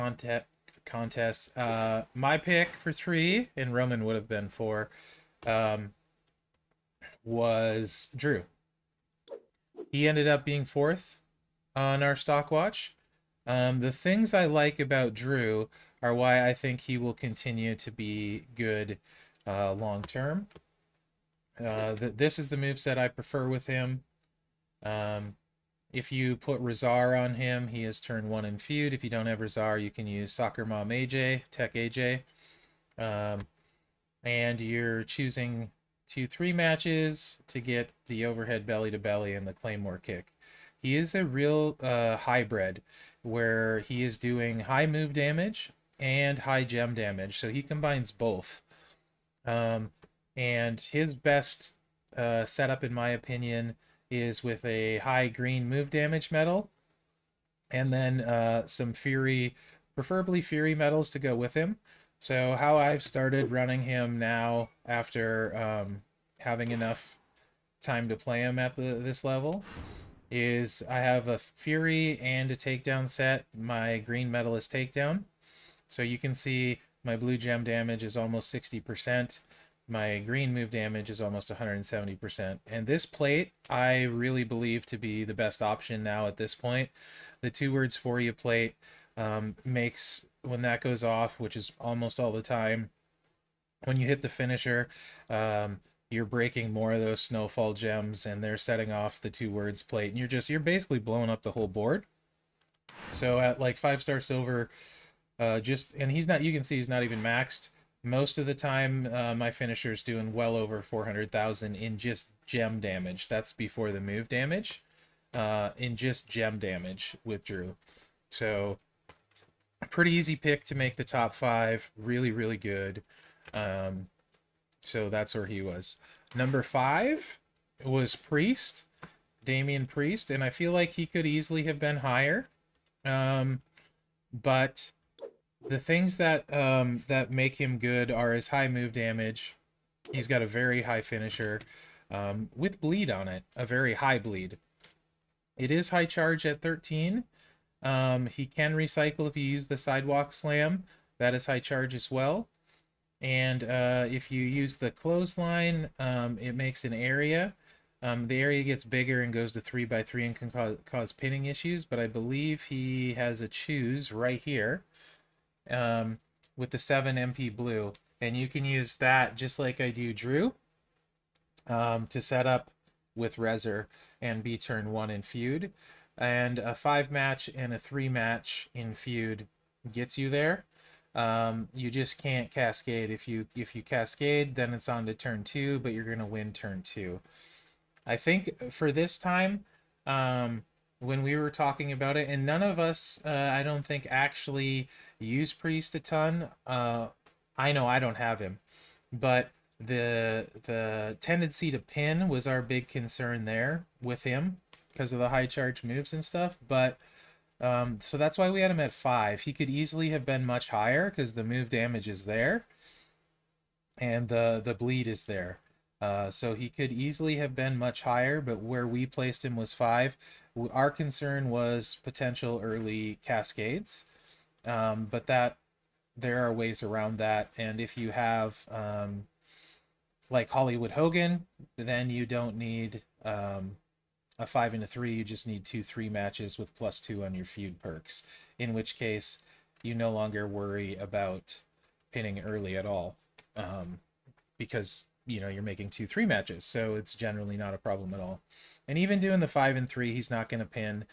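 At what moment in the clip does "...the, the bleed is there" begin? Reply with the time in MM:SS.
03:34.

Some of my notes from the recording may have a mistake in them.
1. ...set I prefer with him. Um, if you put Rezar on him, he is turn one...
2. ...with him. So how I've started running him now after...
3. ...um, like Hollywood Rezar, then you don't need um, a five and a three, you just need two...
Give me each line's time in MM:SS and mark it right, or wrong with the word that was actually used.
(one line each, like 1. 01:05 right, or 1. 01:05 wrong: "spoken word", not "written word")
1. 00:22 right
2. 01:01 right
3. 03:48 wrong: "Hogan", not "Rezar".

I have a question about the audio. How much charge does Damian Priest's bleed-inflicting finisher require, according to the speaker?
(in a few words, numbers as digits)
13.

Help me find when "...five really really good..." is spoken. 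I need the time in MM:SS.
02:01.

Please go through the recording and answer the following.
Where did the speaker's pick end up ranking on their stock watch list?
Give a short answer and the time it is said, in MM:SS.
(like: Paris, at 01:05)
fourth, at 00:10.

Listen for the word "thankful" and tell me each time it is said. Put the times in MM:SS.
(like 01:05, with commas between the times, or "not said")
not said.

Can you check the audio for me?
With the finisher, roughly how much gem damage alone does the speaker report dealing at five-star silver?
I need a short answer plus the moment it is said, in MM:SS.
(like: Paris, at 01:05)
over 400,000, at 01:50.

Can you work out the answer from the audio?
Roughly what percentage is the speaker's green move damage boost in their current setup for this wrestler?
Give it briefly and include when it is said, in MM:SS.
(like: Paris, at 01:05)
almost 170%, at 01:21.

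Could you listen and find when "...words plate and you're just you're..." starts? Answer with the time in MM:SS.
01:39.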